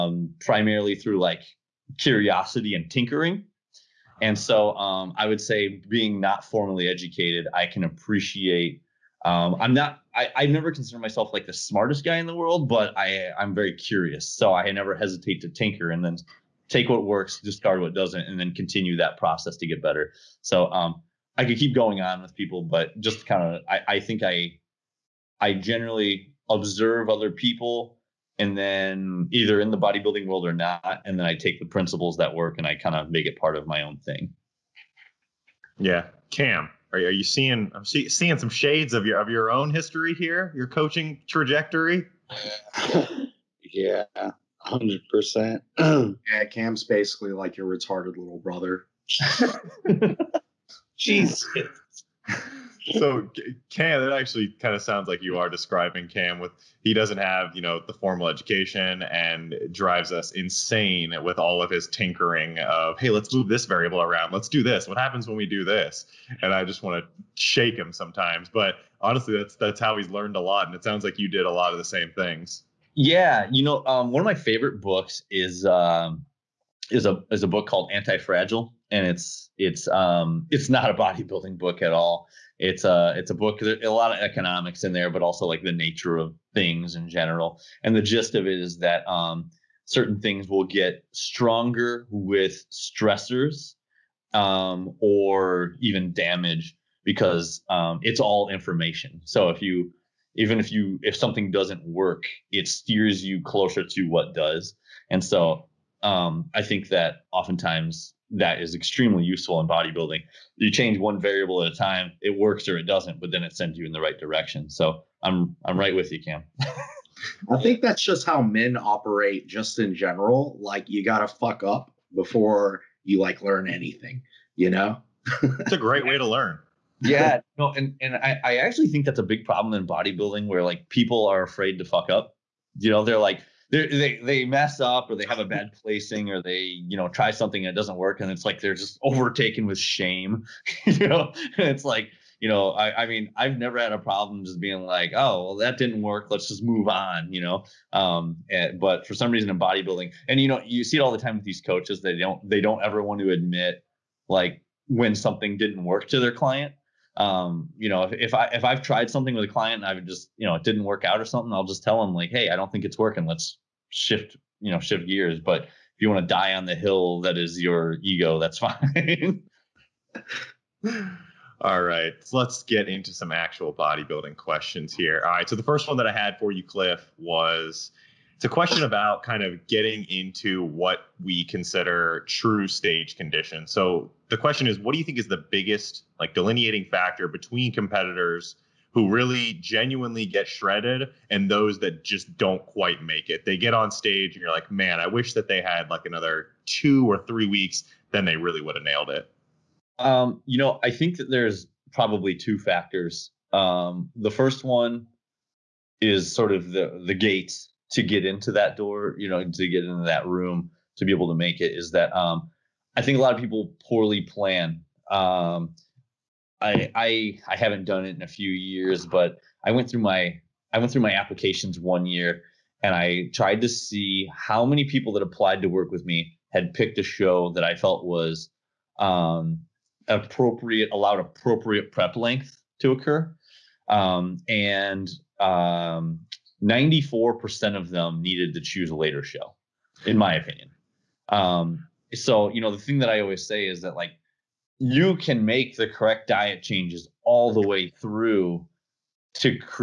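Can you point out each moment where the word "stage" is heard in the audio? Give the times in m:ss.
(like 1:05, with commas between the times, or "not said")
3:02, 3:13.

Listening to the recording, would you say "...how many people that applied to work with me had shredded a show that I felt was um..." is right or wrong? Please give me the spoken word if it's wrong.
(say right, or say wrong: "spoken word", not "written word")
wrong: "picked", not "shredded".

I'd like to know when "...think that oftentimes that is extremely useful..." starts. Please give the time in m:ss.
1:46.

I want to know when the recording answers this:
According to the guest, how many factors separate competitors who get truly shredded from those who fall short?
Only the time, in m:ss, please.
3:22.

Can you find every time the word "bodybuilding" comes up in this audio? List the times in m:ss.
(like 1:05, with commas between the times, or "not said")
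0:29, 1:20, 1:49, 2:09, 2:29, 2:53.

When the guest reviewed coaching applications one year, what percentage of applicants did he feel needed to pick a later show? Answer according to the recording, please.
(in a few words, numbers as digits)
94%.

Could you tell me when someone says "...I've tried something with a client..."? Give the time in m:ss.
2:38.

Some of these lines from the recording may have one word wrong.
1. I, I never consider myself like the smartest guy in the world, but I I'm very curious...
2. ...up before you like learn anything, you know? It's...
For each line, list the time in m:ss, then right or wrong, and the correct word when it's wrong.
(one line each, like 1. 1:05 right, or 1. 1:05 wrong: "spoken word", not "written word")
1. 0:10 right
2. 2:01 right.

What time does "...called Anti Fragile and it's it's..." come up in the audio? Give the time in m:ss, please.
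1:17.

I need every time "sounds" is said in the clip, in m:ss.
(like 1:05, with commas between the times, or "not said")
0:54, 1:10.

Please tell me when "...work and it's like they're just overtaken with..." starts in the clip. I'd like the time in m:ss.
2:17.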